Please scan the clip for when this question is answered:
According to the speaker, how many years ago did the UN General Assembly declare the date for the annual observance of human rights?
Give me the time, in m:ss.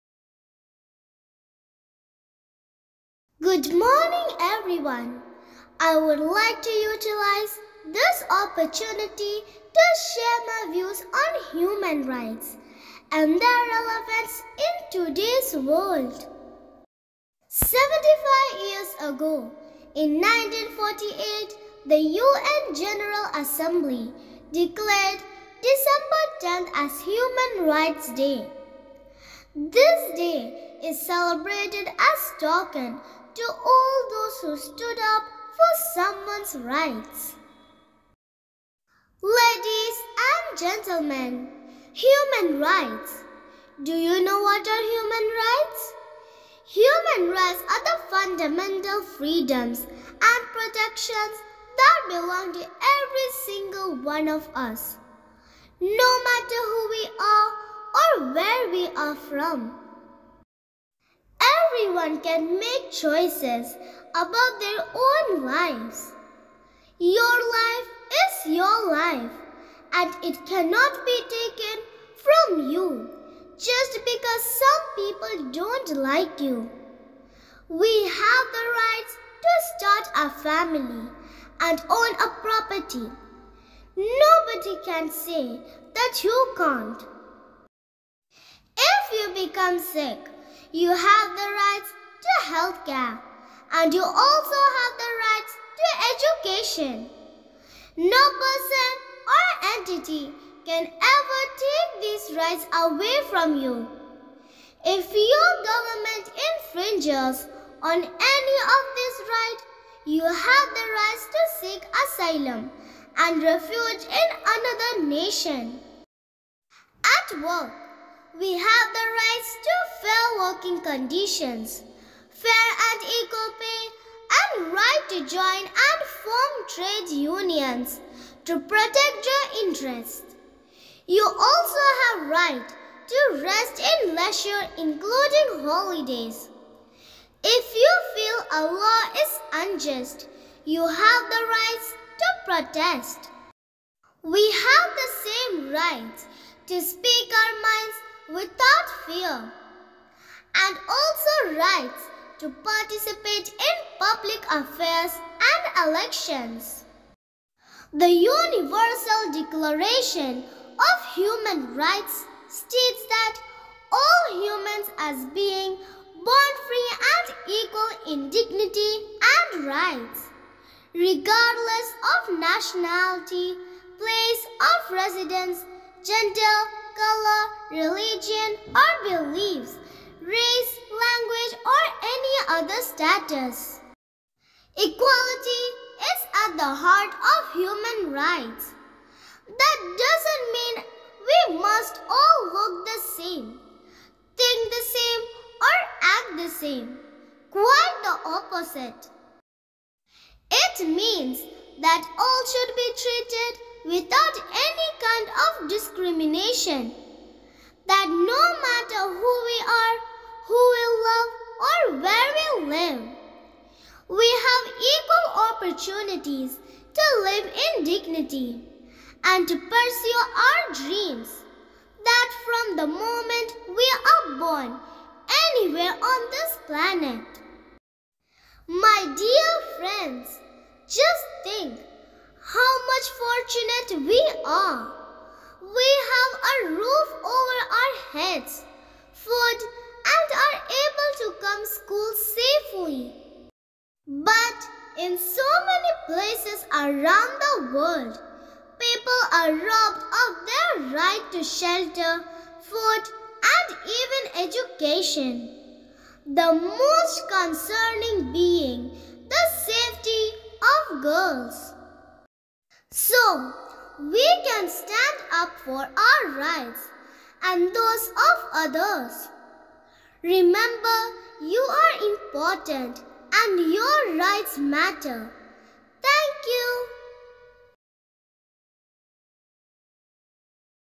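0:17.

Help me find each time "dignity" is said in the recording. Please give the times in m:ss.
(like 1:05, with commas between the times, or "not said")
2:48, 3:37.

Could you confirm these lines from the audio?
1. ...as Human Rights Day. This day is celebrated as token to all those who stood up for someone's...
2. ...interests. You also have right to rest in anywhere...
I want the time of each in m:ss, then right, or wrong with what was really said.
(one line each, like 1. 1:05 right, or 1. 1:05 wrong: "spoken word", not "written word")
1. 0:26 right
2. 2:09 wrong: "leisure", not "anywhere".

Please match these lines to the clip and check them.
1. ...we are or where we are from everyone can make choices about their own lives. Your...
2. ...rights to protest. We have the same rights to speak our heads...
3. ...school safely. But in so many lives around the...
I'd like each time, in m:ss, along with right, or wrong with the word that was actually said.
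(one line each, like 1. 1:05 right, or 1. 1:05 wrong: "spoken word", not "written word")
1. 0:56 right
2. 2:21 wrong: "minds", not "heads"
3. 4:01 wrong: "places", not "lives".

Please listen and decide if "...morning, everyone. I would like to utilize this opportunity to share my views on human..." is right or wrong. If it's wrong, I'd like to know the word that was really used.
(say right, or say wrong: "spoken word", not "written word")
right.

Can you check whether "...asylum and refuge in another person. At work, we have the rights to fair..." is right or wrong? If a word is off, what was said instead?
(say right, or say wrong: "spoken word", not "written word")
wrong: "nation", not "person".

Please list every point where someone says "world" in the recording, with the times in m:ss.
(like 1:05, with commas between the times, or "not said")
0:15, 4:07.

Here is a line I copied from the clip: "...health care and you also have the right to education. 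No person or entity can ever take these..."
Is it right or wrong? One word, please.
right.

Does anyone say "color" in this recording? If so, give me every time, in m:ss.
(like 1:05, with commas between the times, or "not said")
2:56.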